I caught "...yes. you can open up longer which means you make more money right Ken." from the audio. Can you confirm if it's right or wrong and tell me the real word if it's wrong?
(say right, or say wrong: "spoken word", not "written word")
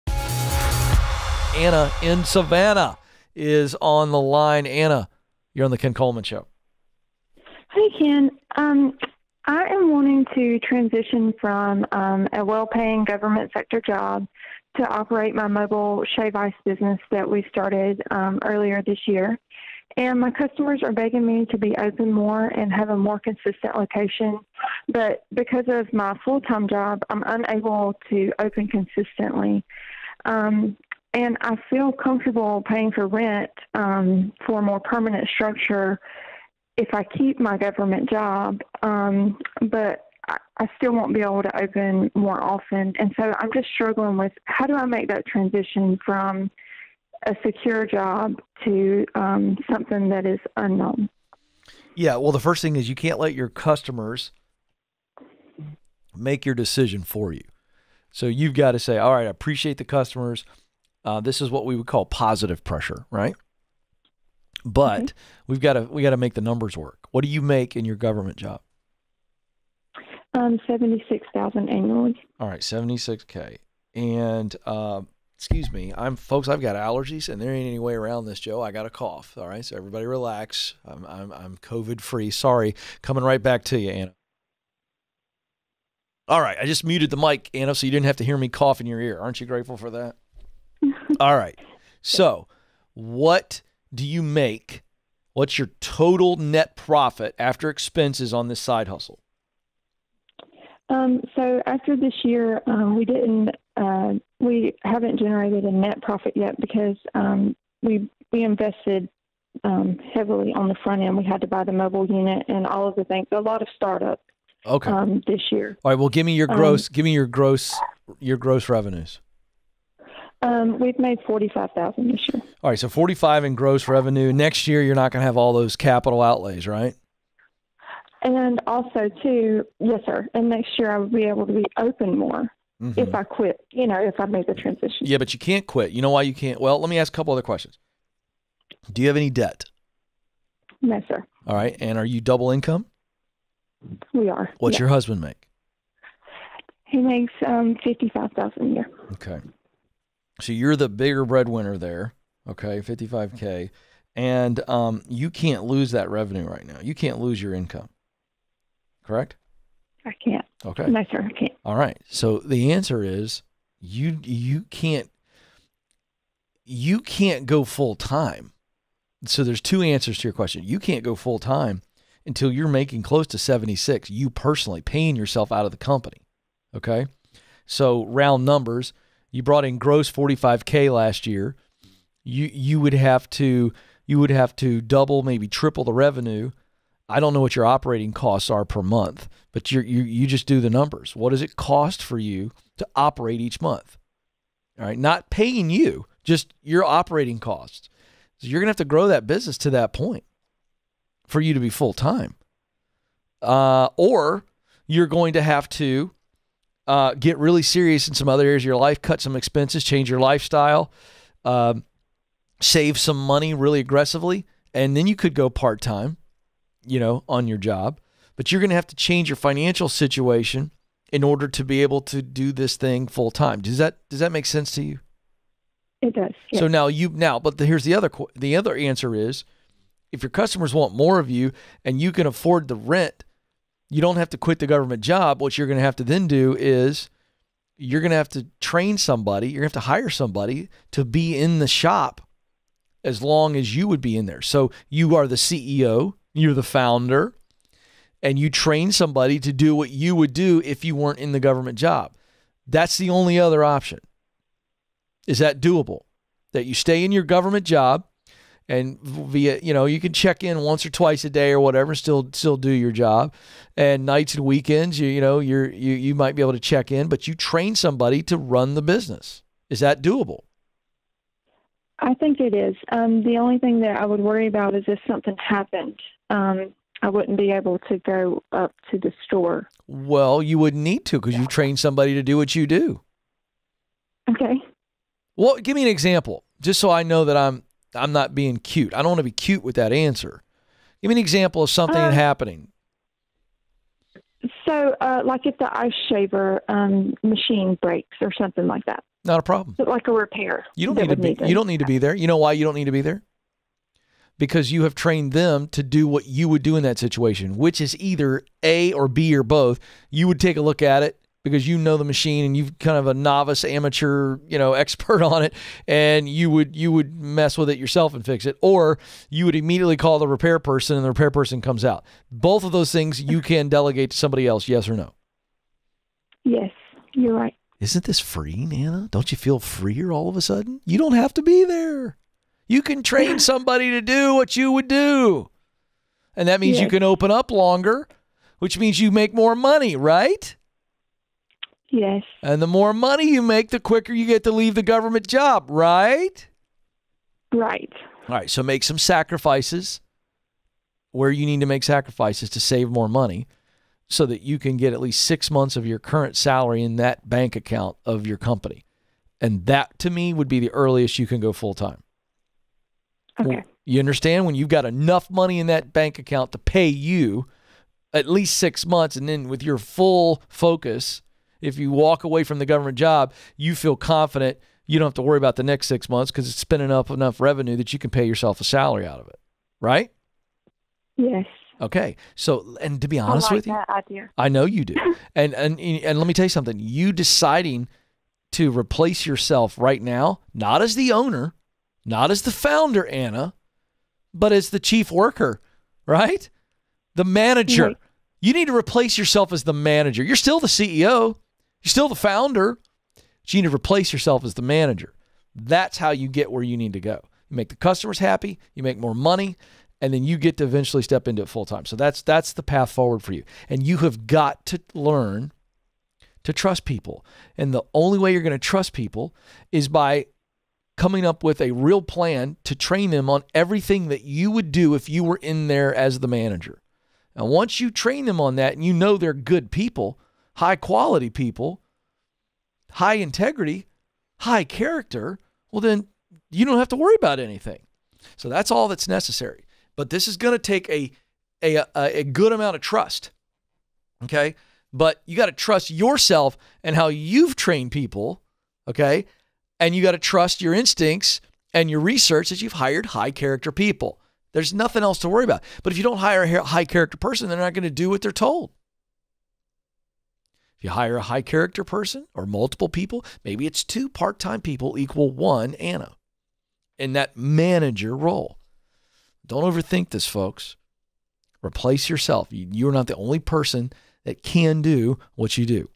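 wrong: "Yes", not "Ken".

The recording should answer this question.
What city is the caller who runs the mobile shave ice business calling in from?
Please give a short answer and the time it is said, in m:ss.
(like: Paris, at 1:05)
Savannah, at 0:02.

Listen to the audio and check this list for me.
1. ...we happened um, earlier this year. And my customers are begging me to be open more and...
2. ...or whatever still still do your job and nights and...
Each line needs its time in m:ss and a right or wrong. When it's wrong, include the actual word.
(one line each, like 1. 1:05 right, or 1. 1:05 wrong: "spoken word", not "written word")
1. 0:17 wrong: "started", not "happened"
2. 4:21 right.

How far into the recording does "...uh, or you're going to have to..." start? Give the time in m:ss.
3:23.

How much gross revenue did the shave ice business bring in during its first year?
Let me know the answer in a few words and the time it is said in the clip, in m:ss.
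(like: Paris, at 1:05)
$45,000, at 2:01.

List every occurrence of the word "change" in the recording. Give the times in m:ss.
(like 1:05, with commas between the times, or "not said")
3:29, 3:38.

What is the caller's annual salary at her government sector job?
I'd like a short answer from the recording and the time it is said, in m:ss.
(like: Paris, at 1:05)
$76,000, at 1:10.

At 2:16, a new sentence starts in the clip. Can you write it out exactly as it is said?
Well, let me ask a couple other questions.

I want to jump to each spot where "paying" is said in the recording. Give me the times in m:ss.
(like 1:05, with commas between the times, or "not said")
0:12, 0:32, 2:54, 3:15.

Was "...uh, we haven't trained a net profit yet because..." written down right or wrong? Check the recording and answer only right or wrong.
wrong.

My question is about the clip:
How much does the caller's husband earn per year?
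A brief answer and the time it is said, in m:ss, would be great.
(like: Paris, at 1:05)
$55,000, at 2:27.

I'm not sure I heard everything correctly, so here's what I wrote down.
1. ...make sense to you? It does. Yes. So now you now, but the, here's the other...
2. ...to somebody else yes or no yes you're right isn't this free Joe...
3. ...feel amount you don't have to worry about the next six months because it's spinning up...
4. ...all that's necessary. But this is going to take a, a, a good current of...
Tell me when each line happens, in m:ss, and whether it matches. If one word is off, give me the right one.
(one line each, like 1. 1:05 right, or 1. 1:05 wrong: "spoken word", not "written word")
1. 3:44 right
2. 5:24 wrong: "Anna", not "Joe"
3. 6:13 wrong: "confident", not "amount"
4. 7:18 wrong: "amount", not "current".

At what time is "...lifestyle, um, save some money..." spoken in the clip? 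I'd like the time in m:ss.
3:30.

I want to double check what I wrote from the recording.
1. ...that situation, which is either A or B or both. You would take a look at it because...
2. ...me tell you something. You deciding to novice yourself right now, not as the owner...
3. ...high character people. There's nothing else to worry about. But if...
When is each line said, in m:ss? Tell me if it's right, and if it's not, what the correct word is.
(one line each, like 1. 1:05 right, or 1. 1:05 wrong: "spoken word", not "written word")
1. 5:06 right
2. 6:26 wrong: "replace", not "novice"
3. 7:33 right.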